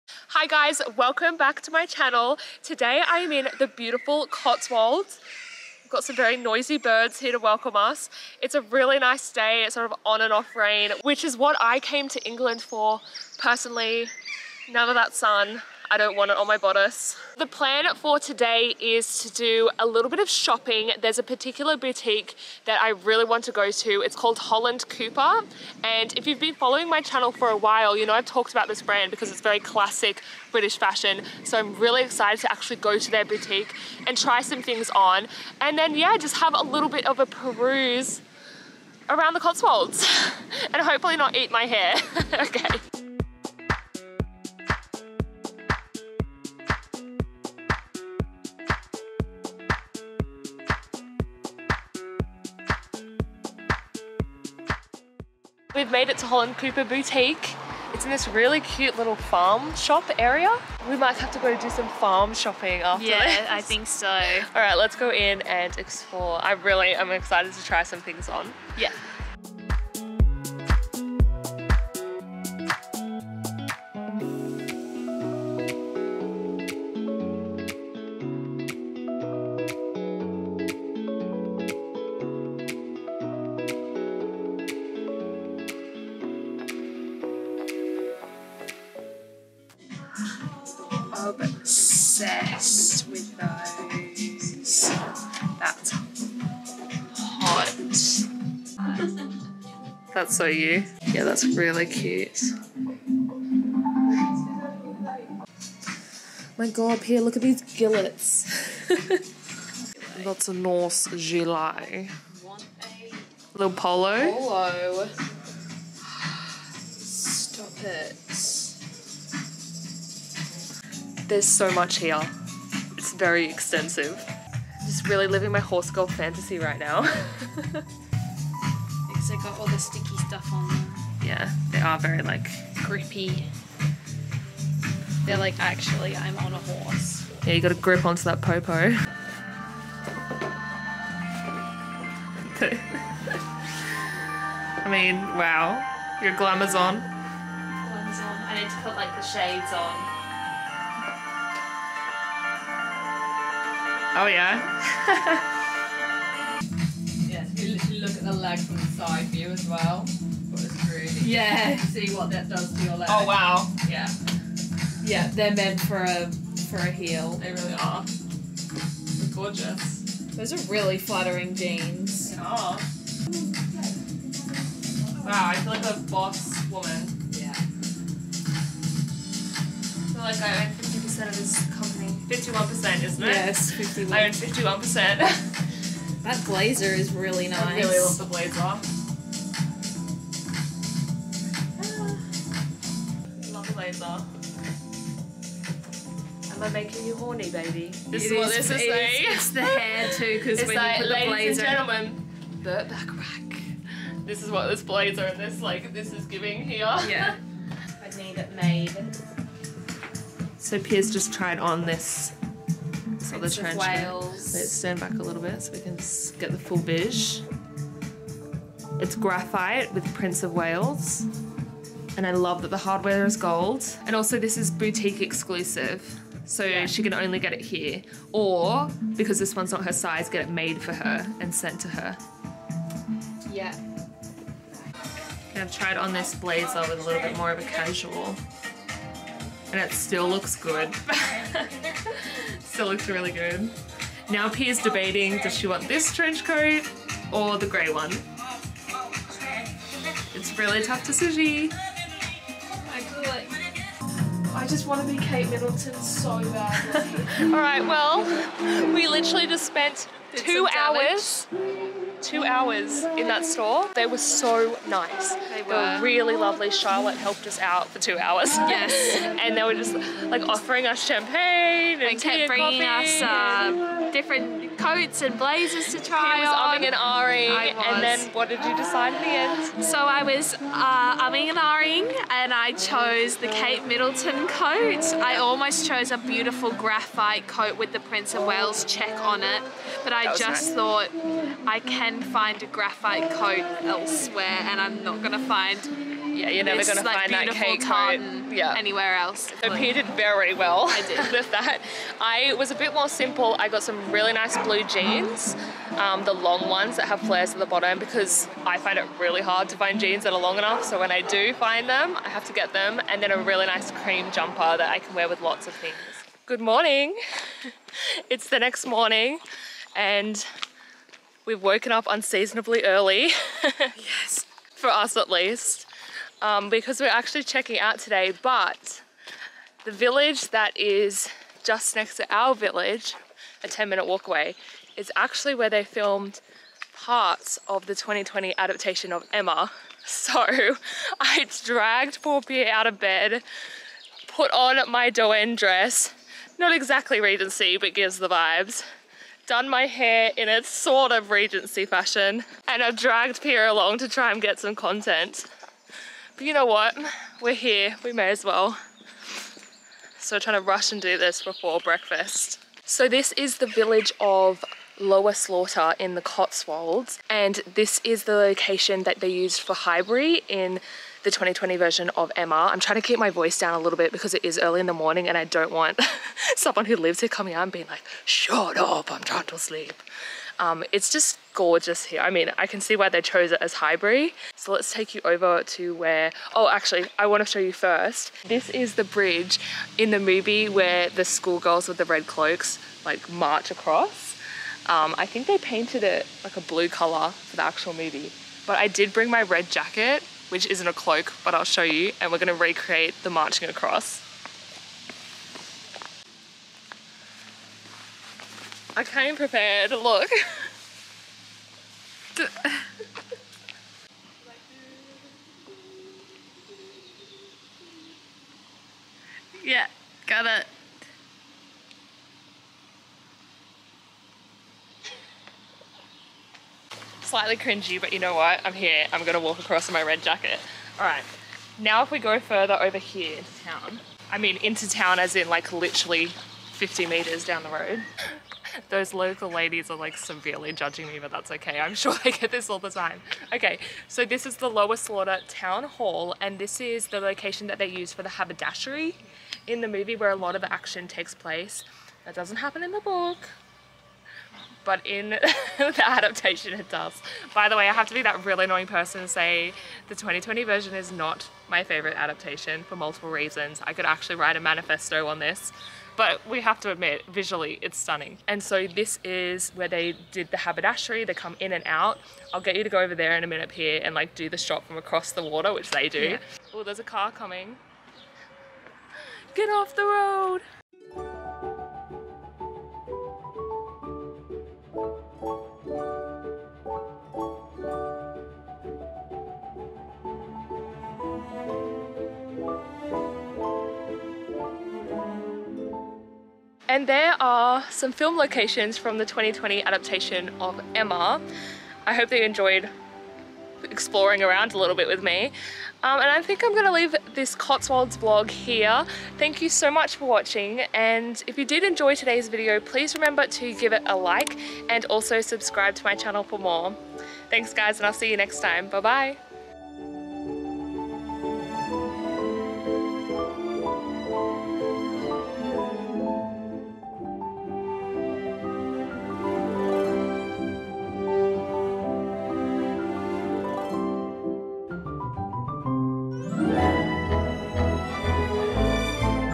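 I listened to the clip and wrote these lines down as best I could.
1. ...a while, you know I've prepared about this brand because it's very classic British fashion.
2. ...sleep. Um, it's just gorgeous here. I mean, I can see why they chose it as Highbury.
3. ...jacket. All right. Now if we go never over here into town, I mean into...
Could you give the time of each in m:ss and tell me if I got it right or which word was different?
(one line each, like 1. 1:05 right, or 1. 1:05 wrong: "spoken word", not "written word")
1. 0:27 wrong: "talked", not "prepared"
2. 6:19 right
3. 7:10 wrong: "further", not "never".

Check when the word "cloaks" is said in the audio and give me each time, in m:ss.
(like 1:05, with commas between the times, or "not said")
6:32, 6:40.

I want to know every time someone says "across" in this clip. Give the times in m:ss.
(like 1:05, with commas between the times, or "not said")
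6:33, 6:43, 7:09, 7:54.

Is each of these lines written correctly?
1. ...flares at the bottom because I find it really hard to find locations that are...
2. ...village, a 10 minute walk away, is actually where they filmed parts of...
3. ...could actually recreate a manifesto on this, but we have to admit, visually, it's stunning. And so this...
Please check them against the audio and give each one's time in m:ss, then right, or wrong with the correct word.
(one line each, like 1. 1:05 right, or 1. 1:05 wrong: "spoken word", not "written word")
1. 5:07 wrong: "jeans", not "locations"
2. 5:32 right
3. 7:43 wrong: "write", not "recreate".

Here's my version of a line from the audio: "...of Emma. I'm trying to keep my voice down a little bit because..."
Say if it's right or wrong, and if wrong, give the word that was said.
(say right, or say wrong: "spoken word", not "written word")
right.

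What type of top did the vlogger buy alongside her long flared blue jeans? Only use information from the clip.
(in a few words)
cream jumper.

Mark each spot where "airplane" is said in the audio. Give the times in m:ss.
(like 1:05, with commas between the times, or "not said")
not said.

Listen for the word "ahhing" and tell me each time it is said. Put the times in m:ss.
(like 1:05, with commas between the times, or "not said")
4:36, 4:41.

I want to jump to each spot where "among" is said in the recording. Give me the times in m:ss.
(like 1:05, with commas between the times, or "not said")
not said.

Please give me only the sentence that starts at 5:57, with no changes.
We're here, we may as well.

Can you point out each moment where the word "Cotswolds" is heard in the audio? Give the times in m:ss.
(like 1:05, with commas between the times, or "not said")
0:04, 0:39, 6:06, 8:27.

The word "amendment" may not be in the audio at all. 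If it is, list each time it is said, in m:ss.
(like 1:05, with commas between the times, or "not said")
not said.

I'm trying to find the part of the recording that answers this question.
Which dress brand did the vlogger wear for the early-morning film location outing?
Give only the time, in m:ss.
5:45.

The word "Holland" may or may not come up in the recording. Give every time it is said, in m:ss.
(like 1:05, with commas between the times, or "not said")
0:24, 0:56.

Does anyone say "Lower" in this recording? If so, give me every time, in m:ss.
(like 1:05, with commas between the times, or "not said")
6:04, 7:24.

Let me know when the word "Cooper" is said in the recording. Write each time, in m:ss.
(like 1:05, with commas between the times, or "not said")
0:24, 0:56.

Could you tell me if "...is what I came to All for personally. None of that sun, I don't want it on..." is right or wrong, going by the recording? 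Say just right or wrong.
wrong.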